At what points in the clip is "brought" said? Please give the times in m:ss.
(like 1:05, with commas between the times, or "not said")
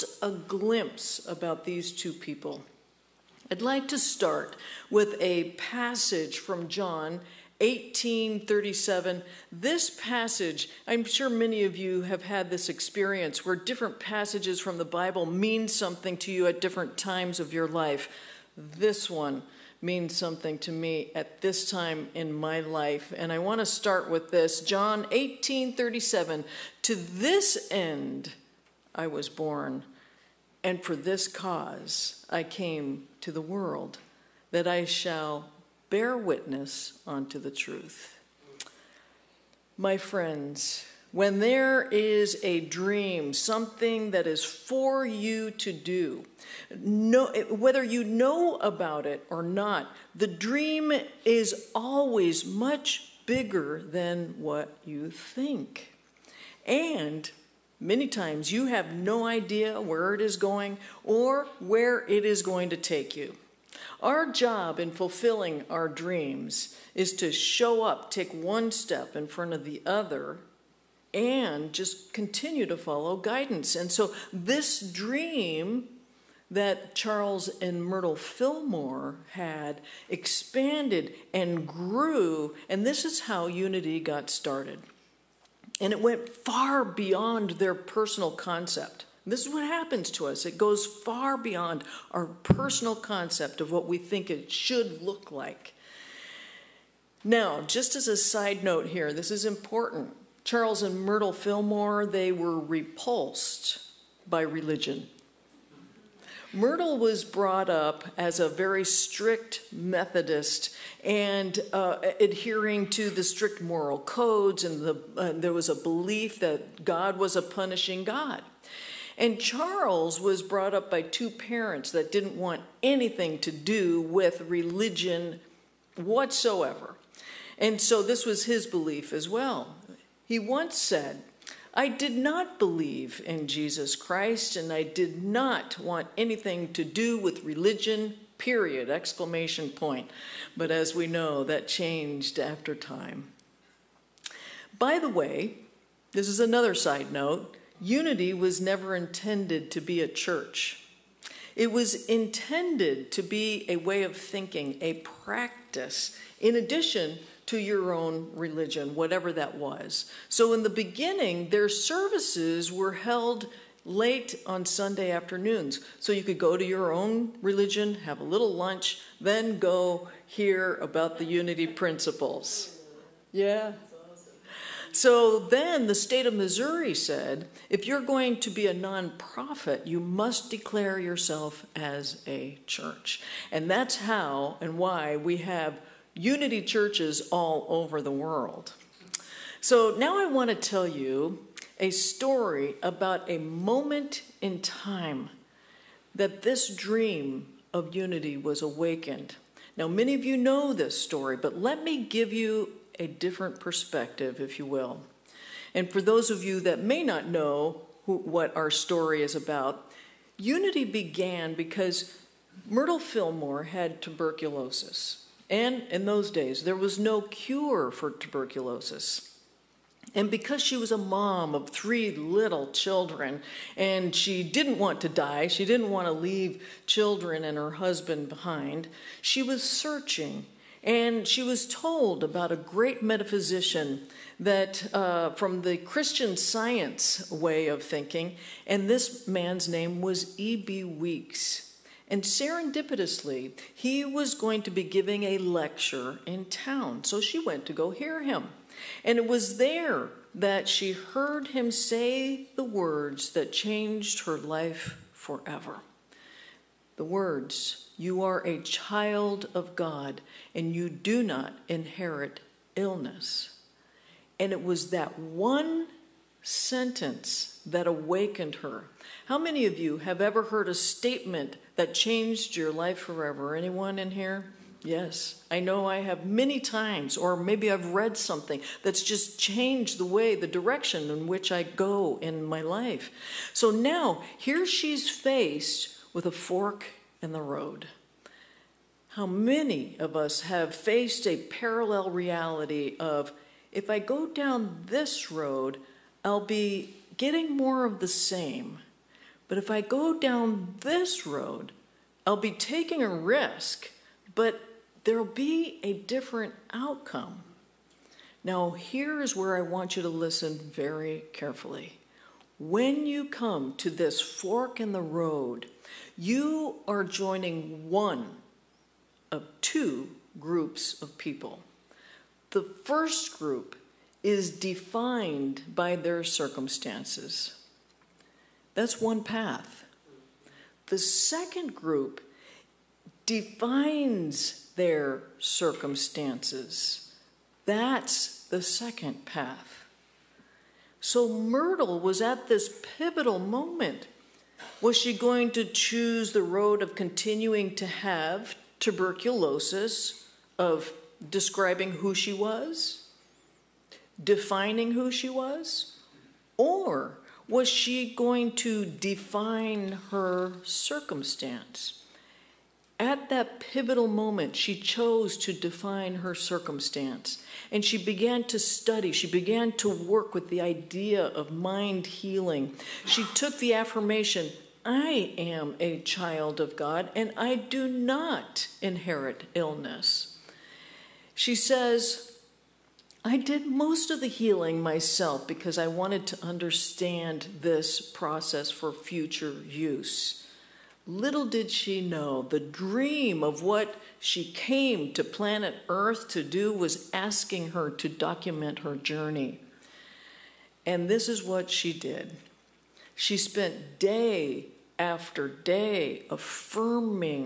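1:47, 2:00.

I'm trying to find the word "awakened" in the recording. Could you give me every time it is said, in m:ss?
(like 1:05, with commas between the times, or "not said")
3:18, 4:27.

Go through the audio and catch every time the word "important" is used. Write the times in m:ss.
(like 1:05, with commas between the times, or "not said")
1:39.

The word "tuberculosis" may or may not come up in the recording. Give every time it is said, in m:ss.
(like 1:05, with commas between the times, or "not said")
3:34, 3:38, 5:48.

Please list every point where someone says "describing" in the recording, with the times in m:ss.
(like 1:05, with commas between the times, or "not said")
5:51.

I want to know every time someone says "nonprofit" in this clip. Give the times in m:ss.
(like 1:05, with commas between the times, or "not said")
2:58.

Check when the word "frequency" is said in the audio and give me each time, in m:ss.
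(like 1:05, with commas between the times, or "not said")
not said.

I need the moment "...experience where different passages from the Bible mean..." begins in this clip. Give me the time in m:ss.
0:12.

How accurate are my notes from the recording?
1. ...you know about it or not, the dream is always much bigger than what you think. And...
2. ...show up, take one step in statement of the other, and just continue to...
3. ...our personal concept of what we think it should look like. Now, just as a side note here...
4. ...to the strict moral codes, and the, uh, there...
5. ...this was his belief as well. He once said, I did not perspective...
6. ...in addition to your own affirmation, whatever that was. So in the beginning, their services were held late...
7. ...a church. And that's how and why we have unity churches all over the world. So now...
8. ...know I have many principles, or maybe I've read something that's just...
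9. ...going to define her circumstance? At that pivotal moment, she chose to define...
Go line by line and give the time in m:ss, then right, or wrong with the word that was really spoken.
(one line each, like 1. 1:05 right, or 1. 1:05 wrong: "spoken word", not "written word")
1. 0:47 right
2. 1:07 wrong: "front", not "statement"
3. 1:32 right
4. 1:52 right
5. 2:08 wrong: "believe", not "perspective"
6. 2:36 wrong: "religion", not "affirmation"
7. 3:02 right
8. 4:35 wrong: "times", not "principles"
9. 5:58 right.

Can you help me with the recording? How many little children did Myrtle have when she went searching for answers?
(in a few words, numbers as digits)
3.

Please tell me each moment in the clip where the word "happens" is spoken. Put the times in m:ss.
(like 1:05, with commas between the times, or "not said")
1:29.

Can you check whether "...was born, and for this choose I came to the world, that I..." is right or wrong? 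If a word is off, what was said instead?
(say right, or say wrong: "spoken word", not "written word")
wrong: "cause", not "choose".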